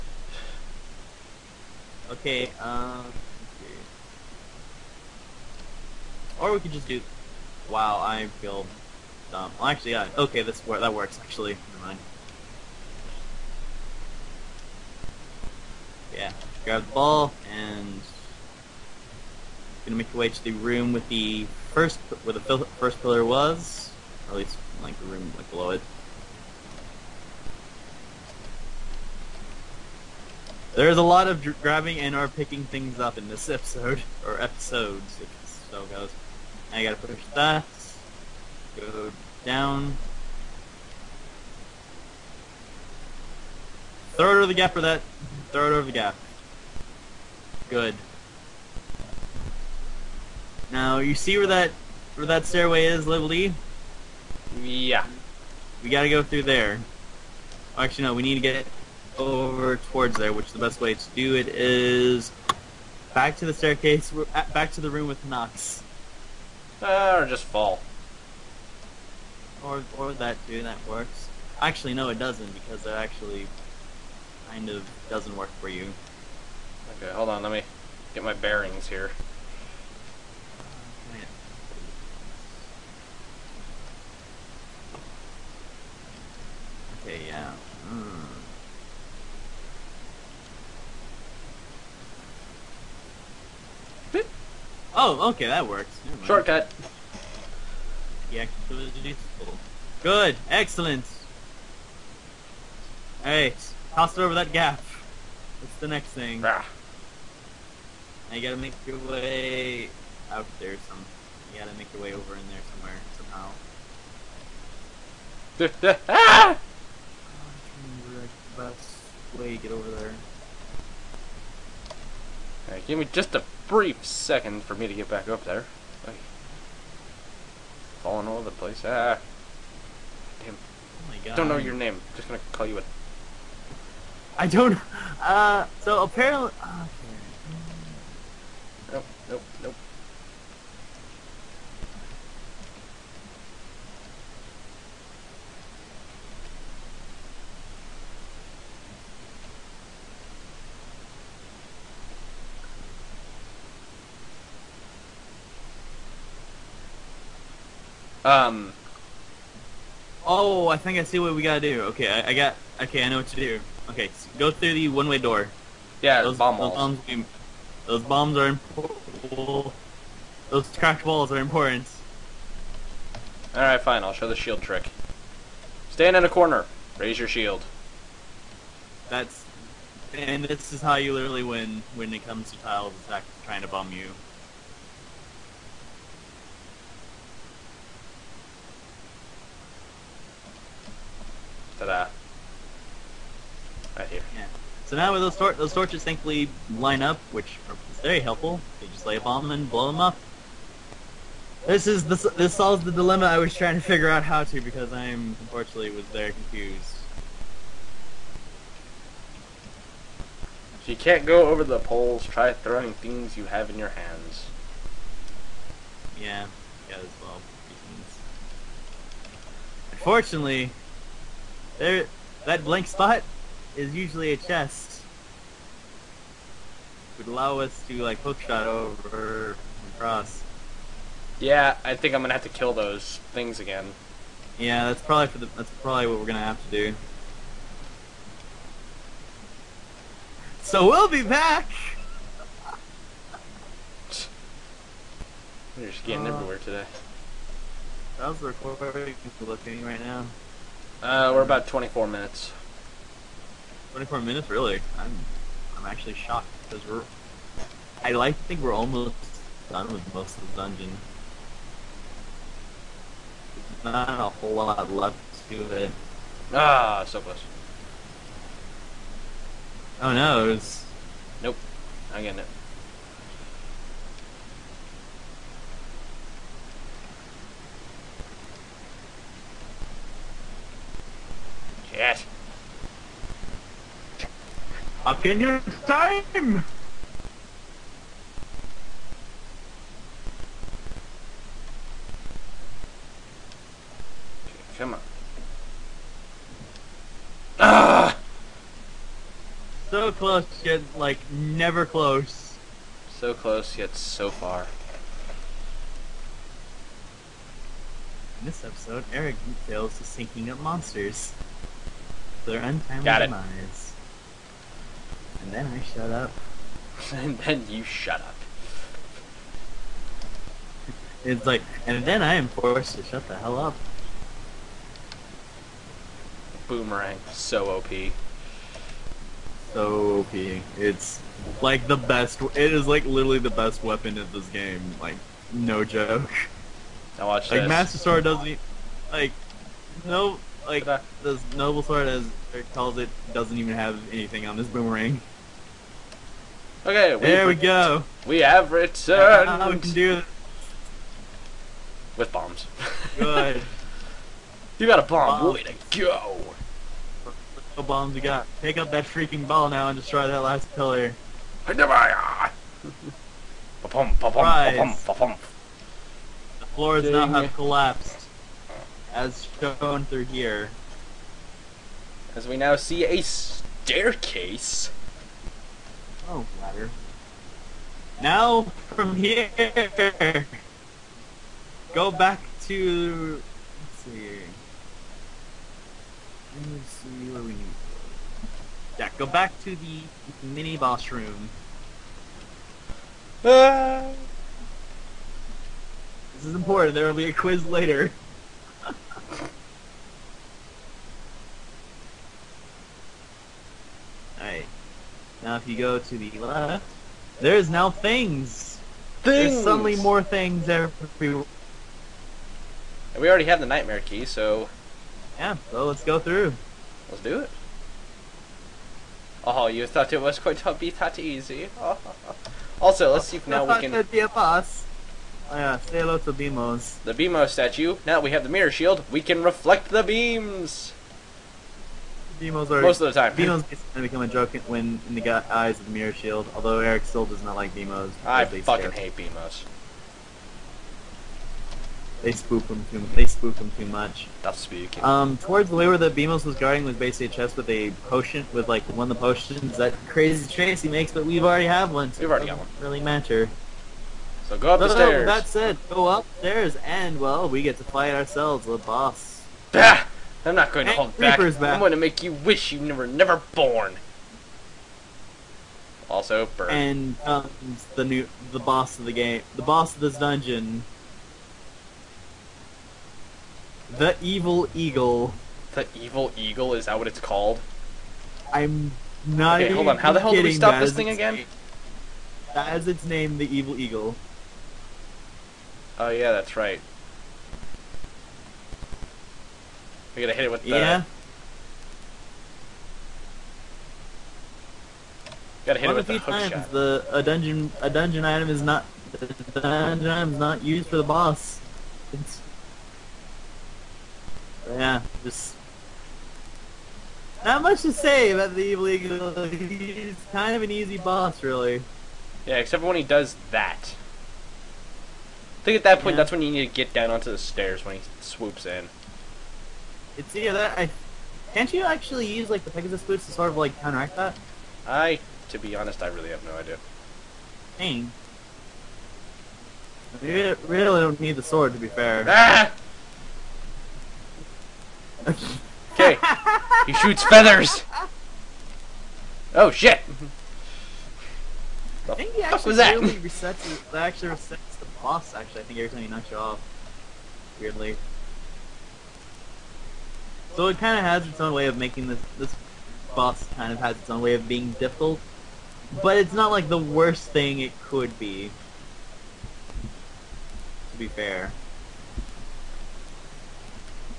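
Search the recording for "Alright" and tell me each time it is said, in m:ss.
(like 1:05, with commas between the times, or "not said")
1:43, 2:02, 6:44.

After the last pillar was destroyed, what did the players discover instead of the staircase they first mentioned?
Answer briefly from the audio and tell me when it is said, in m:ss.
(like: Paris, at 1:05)
Ladder, at 6:16.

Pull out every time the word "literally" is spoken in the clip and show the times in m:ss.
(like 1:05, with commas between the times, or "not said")
3:01, 5:33.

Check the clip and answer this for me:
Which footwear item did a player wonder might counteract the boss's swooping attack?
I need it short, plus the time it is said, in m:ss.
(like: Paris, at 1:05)
Pegasus boots, at 8:42.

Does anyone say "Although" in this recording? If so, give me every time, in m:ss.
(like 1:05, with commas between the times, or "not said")
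7:16.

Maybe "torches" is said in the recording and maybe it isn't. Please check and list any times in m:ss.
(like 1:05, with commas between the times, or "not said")
3:15.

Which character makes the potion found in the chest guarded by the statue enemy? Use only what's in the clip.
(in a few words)
Crazy Tracy.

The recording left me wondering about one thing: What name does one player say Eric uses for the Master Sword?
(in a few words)
The noble sword.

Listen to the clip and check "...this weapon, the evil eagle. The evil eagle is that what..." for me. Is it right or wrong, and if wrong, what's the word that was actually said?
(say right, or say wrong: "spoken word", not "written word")
wrong: "dungeon", not "weapon".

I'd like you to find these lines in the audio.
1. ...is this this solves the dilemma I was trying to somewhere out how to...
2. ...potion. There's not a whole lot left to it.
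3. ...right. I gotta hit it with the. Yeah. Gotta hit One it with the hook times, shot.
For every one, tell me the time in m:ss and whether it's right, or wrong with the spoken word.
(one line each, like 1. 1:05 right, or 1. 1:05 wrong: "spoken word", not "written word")
1. 3:21 wrong: "figure", not "somewhere"
2. 4:20 wrong: "dungeon", not "potion"
3. 8:06 right.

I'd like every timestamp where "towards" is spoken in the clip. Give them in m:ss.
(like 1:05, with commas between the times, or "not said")
0:59, 7:25.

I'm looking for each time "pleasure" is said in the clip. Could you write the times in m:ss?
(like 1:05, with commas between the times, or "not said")
not said.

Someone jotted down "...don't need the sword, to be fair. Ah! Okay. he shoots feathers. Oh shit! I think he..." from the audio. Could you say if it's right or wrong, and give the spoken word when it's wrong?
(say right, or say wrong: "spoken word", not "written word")
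right.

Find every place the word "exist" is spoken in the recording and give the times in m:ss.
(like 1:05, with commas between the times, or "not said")
not said.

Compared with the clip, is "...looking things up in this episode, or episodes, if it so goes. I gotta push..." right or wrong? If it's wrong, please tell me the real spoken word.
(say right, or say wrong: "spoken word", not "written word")
wrong: "picking", not "looking".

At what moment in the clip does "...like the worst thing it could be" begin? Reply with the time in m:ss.
9:16.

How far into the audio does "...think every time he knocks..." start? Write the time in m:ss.
9:05.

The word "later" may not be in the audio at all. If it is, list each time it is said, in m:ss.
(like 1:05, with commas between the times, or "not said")
6:37.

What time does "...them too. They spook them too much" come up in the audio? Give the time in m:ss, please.
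7:22.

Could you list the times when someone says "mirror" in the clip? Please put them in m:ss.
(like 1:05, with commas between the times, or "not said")
7:08, 7:15.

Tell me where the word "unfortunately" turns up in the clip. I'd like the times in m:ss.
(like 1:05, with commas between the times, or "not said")
3:25, 3:39.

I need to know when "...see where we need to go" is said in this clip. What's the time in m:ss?
6:26.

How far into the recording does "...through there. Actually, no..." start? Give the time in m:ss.
0:56.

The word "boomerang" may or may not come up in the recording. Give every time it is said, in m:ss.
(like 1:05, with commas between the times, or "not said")
5:26, 5:44.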